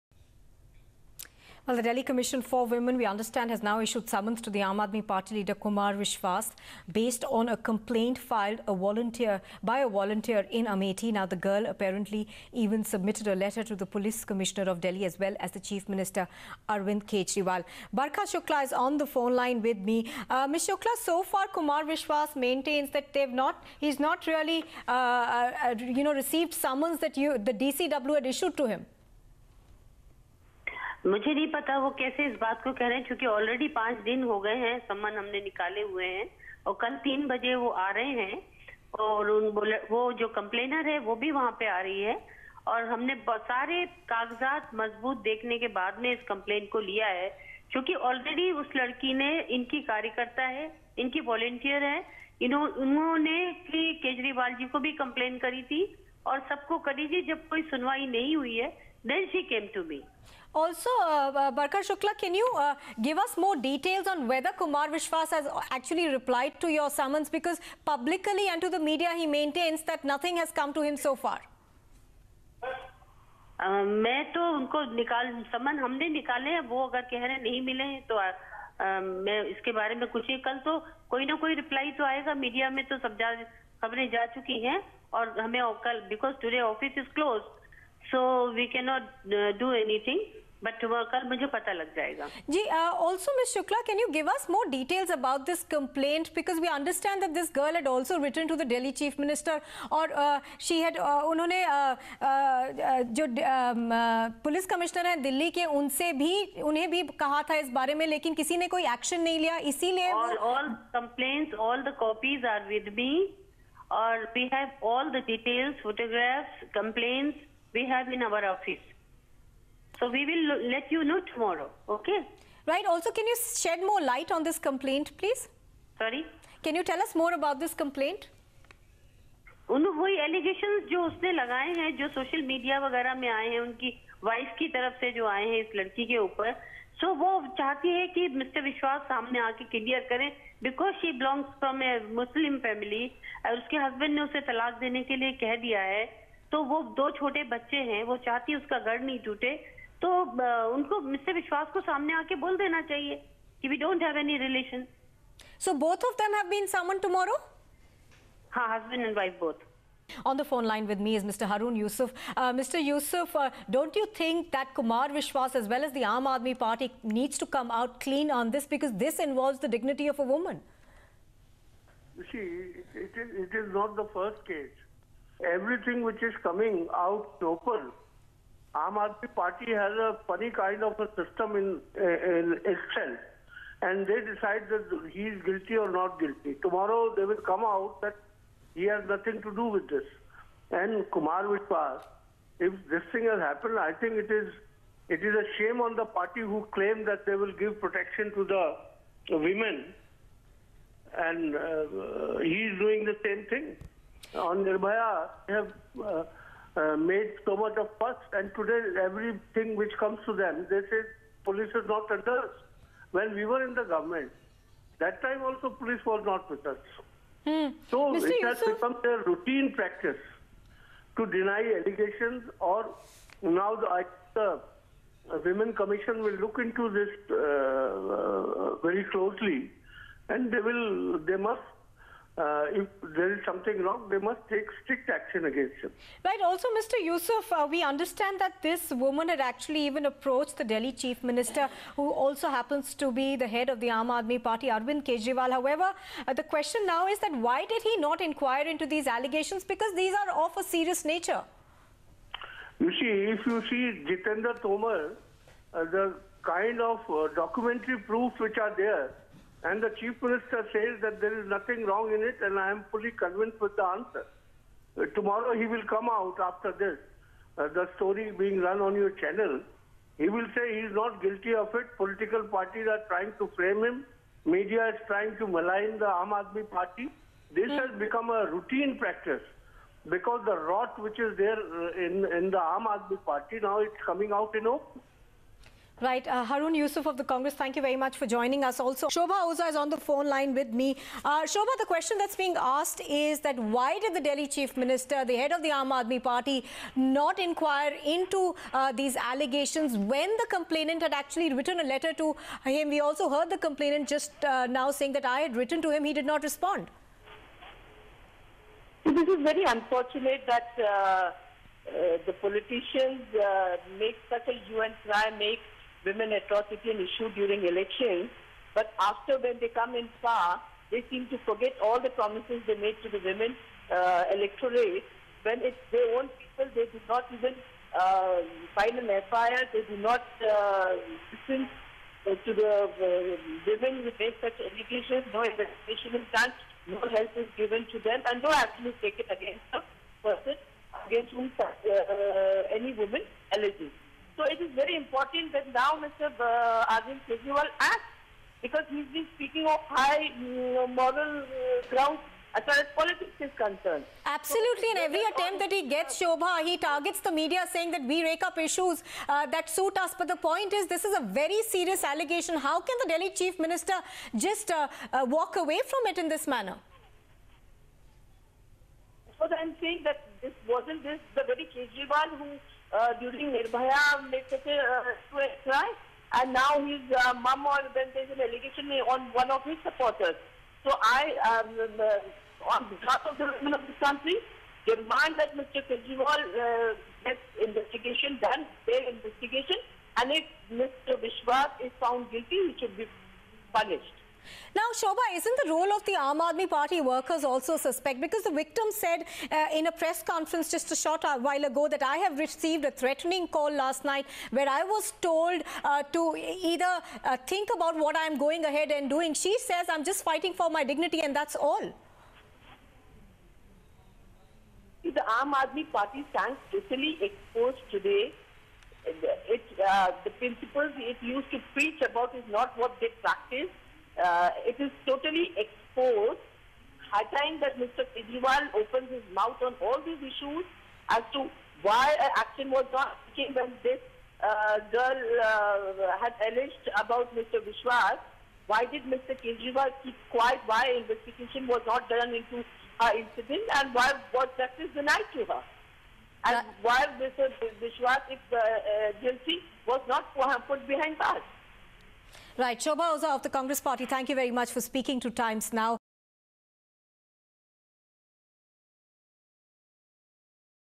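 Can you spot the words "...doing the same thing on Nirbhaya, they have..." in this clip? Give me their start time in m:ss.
3:22.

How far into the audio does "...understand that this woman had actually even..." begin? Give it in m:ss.
3:57.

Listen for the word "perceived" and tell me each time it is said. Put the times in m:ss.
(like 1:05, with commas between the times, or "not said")
not said.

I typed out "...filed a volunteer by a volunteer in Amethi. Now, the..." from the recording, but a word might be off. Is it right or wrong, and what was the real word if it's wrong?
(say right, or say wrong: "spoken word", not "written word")
right.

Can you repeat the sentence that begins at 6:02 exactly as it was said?
How can the Delhi Chief Minister just uh, uh, walk away from it in this manner?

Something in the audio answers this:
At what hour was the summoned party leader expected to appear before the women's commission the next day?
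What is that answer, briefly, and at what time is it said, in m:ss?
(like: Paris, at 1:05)
3 o'clock, at 0:37.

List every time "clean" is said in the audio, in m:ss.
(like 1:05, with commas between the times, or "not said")
2:48.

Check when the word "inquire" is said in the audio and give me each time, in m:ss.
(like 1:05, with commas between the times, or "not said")
4:08, 4:57.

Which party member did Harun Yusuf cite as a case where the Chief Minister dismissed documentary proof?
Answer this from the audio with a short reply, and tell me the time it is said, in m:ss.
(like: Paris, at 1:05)
Jitendra Tomar, at 4:14.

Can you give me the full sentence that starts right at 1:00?
Also, uh, Barkar Shukla, can you uh, give us more details on whether Kumar Vishwas has actually replied to your summons?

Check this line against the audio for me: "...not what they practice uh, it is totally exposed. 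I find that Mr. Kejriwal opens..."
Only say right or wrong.
right.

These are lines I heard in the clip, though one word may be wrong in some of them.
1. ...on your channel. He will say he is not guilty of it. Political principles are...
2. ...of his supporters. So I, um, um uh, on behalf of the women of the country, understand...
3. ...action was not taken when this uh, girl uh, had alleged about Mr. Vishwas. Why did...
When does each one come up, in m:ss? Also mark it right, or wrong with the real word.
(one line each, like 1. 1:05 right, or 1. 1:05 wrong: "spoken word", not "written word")
1. 4:28 wrong: "parties", not "principles"
2. 6:19 wrong: "demand", not "understand"
3. 7:12 right.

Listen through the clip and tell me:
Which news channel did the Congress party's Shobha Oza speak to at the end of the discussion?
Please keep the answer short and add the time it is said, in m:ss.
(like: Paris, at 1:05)
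Times Now, at 7:35.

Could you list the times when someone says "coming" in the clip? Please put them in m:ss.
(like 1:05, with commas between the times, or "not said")
2:56, 4:44.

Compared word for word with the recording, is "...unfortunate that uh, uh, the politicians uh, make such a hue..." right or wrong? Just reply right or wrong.
right.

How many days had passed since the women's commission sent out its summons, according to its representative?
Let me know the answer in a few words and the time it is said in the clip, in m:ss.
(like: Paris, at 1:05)
5, at 0:33.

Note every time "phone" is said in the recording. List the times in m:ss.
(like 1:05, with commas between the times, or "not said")
0:19, 2:40, 4:49.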